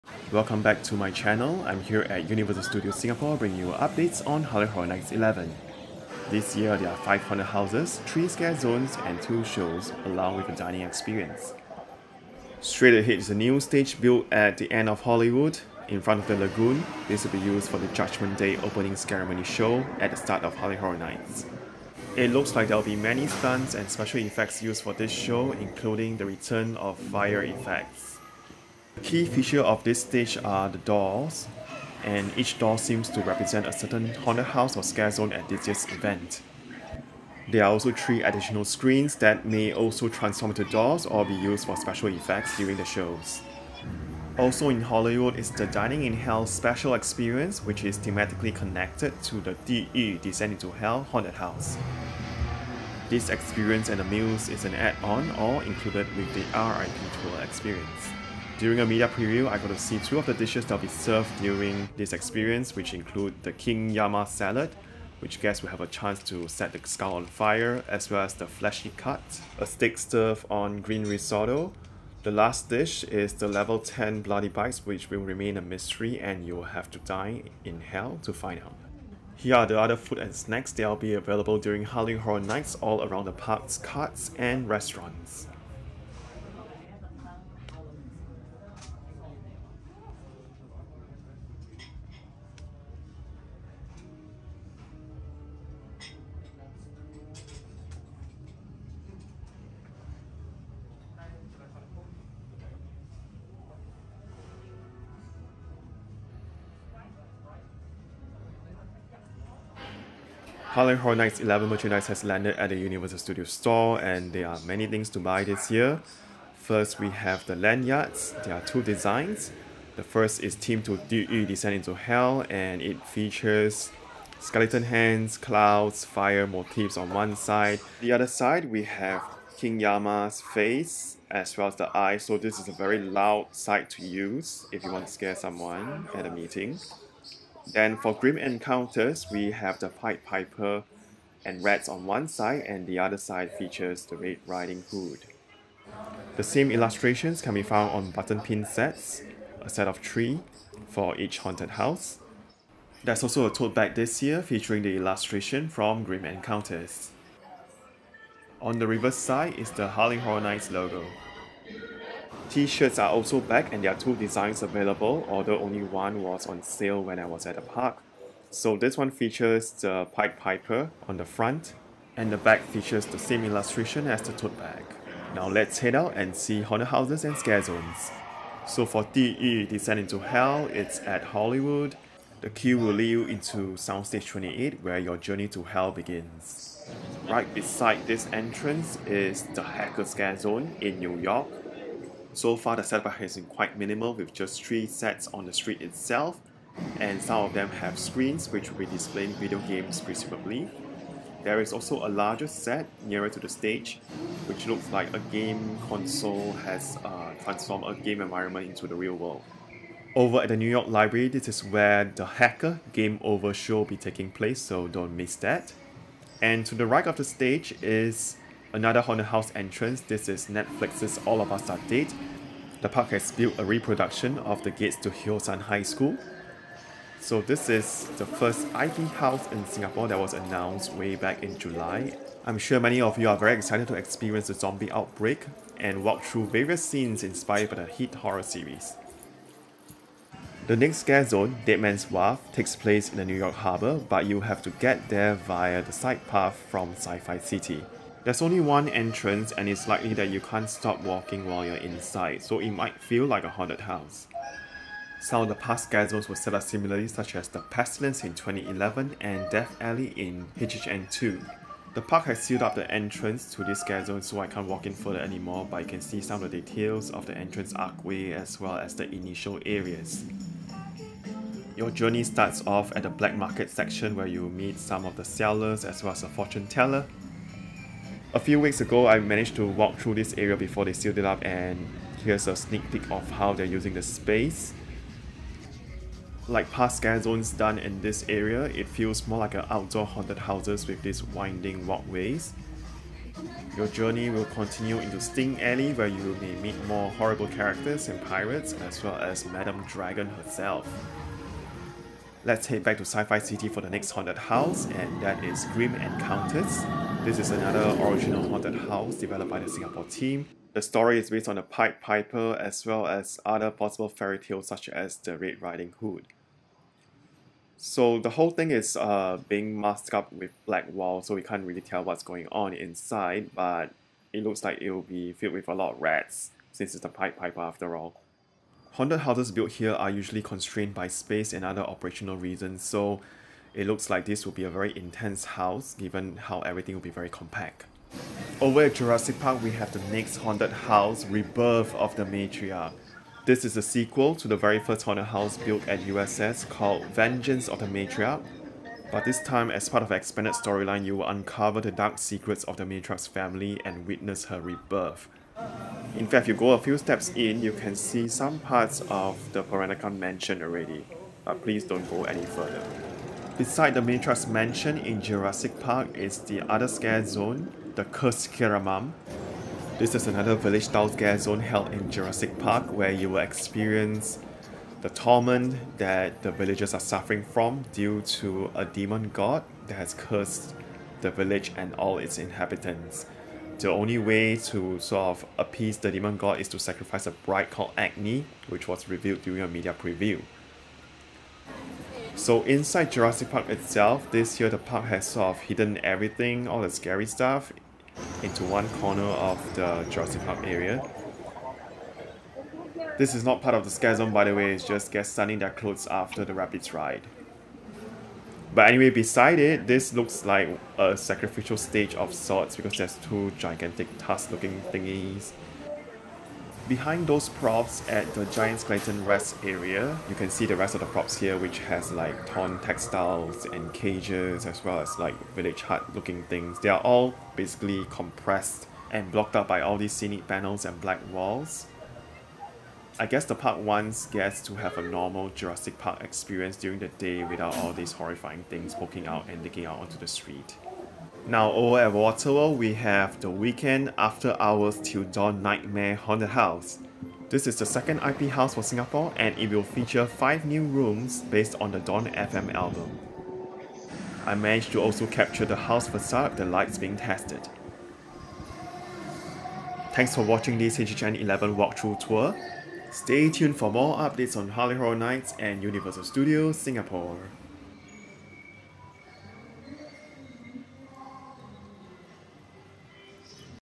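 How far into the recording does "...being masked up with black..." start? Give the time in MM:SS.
05:19.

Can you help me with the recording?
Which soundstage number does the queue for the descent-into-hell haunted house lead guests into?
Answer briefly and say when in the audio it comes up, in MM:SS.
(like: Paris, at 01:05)
28, at 03:03.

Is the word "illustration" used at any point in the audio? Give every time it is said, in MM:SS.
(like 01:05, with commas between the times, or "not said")
02:26, 02:34, 02:53.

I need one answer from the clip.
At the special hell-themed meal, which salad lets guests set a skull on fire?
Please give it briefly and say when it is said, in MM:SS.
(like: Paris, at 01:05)
King Yama salad, at 01:03.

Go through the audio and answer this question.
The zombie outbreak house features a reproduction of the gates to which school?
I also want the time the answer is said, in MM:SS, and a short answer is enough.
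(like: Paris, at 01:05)
Hyosan High School, at 03:45.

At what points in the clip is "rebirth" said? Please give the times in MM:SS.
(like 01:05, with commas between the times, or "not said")
05:41, 05:54.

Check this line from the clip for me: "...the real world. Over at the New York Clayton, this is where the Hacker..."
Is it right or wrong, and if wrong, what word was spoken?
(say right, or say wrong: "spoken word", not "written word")
wrong: "Library", not "Clayton".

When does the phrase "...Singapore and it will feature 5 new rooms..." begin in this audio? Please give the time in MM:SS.
07:28.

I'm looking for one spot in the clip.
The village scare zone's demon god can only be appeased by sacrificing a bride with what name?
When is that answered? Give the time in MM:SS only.
06:27.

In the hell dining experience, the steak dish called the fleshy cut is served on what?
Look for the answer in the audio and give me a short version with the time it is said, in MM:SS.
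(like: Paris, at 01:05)
green risotto, at 01:10.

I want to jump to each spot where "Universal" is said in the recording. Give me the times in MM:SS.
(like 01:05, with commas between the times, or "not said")
00:02, 01:52, 07:45.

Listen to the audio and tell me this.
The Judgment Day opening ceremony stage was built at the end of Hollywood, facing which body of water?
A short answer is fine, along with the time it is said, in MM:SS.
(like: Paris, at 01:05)
the lagoon, at 00:16.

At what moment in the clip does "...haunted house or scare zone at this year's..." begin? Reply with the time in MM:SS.
00:34.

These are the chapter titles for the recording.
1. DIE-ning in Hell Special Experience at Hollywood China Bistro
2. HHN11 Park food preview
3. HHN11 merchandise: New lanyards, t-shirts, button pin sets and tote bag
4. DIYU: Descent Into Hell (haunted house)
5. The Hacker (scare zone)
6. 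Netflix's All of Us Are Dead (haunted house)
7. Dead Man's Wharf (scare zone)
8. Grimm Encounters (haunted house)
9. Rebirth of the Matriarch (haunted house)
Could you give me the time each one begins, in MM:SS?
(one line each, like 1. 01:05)
1. 00:43
2. 01:19
3. 01:50
4. 02:57
5. 03:07
6. 03:36
7. 04:00
8. 05:04
9. 05:38.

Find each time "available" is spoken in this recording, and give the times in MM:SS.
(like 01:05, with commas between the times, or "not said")
01:21, 02:44.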